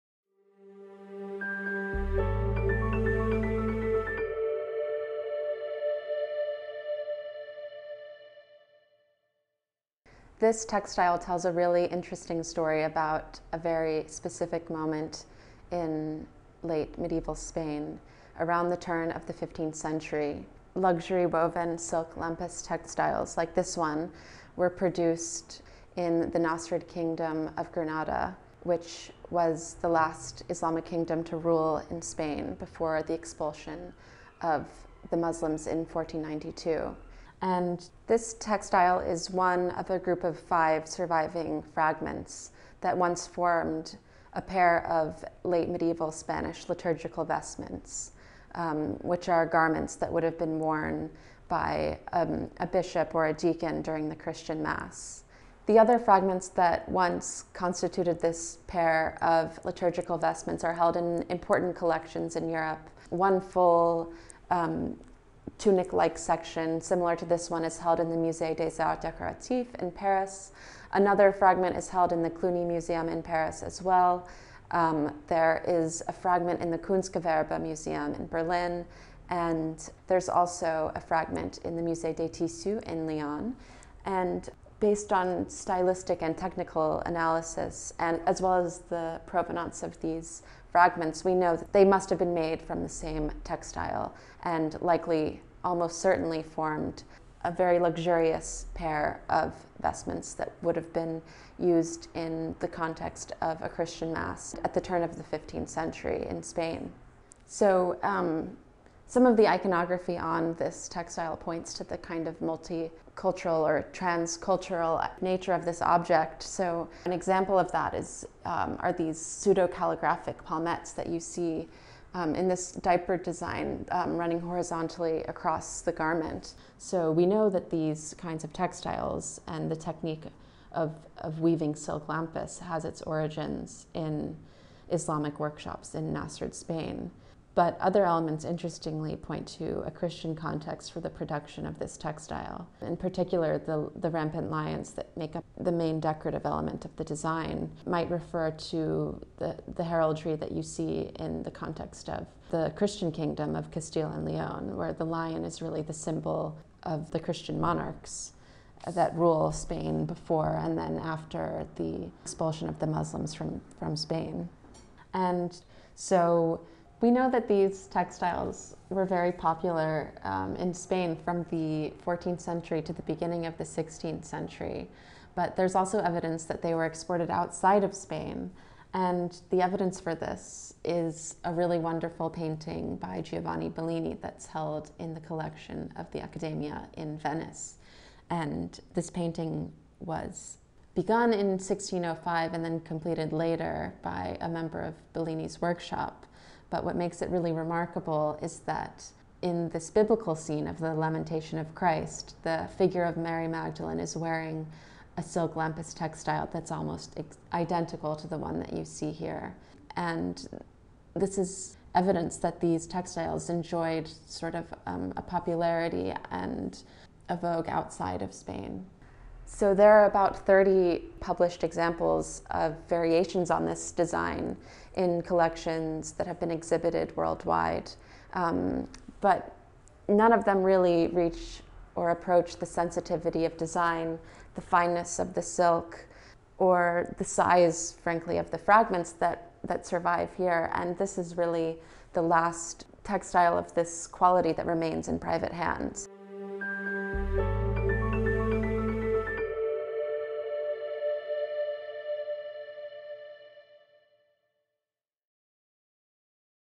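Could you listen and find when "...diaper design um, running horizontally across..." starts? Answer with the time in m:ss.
2:02.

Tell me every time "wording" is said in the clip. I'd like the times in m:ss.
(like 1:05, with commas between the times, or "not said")
not said.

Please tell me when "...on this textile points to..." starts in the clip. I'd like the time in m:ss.
1:50.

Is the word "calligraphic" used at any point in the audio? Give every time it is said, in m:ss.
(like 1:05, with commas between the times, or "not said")
1:59.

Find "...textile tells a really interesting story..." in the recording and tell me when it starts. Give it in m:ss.
0:10.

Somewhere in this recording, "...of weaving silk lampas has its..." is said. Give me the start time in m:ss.
2:11.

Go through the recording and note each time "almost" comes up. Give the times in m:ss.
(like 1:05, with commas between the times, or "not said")
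1:35, 3:26.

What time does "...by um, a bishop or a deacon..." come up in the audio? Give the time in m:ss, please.
0:51.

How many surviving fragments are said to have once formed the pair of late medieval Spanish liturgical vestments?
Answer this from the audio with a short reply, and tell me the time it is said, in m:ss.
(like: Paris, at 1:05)
5, at 0:40.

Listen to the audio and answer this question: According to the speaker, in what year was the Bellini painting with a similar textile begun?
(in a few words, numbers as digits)
1605.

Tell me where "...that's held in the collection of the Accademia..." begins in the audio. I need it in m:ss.
3:04.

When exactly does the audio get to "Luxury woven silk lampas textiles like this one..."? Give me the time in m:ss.
0:20.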